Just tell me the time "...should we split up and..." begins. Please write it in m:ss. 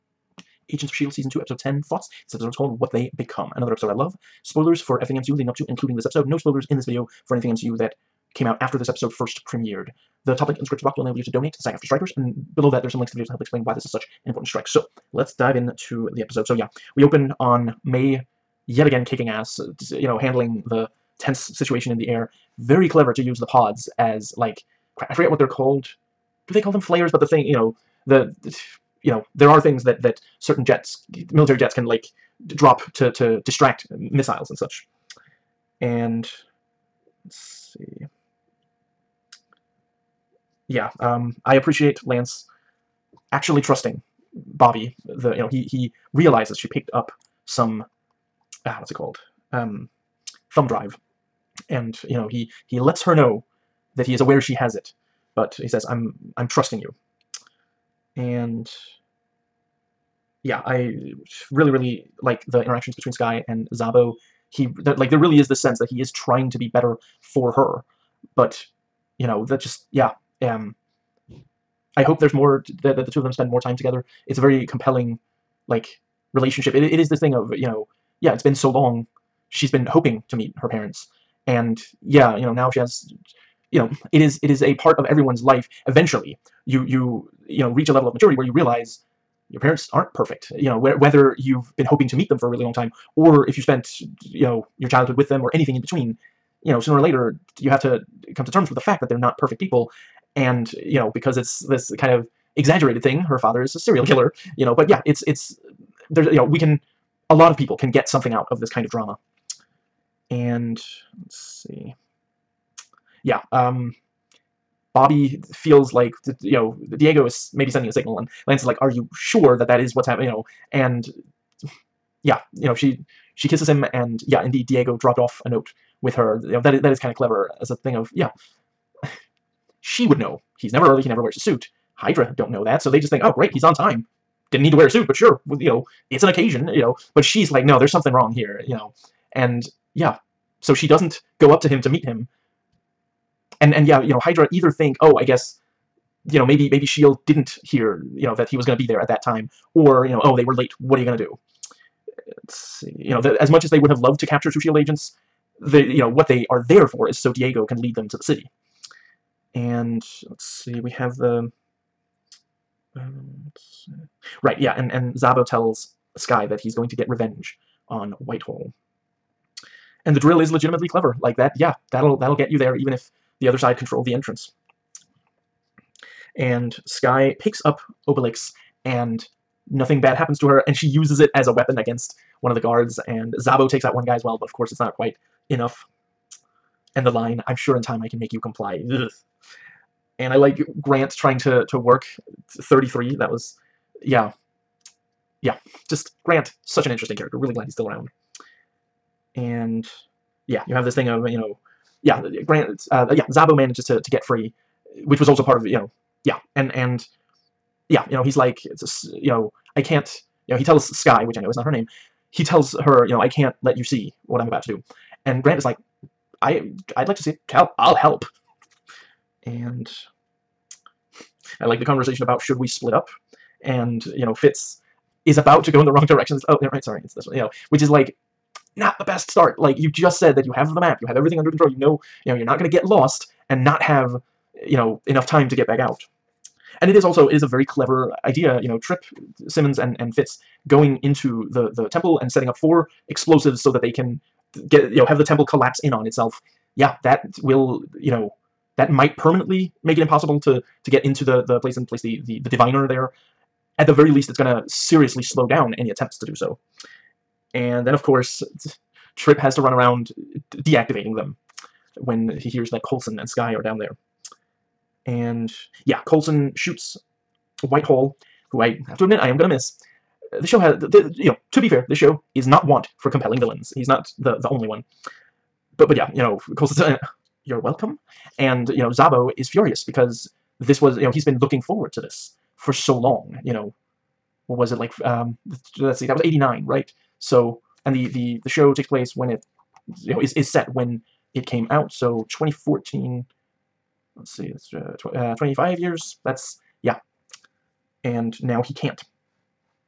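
3:42.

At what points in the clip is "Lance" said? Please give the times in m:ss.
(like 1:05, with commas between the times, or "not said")
0:42, 1:58.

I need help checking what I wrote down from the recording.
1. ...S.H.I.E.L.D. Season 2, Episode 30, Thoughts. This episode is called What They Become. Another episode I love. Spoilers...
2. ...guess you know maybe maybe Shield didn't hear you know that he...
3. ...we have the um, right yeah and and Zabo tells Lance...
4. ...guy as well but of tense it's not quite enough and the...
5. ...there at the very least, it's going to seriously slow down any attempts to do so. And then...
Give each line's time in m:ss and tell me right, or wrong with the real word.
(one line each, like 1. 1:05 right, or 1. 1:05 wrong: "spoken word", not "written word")
1. 0:00 wrong: "10", not "30"
2. 2:25 right
3. 2:40 wrong: "Skye", not "Lance"
4. 3:04 wrong: "course", not "tense"
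5. 4:12 right.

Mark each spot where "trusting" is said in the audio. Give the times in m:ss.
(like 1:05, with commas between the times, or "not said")
0:43, 0:56.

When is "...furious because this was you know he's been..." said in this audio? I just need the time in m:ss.
4:39.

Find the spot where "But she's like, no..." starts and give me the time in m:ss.
2:17.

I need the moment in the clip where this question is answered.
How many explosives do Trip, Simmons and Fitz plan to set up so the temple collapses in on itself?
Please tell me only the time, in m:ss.
4:02.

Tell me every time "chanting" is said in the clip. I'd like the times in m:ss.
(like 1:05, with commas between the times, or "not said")
not said.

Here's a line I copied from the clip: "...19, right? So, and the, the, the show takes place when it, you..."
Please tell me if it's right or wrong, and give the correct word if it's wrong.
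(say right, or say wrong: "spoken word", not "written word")
wrong: "89", not "19".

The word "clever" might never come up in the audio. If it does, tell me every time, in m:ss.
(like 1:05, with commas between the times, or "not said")
0:22, 2:07, 2:50, 3:57.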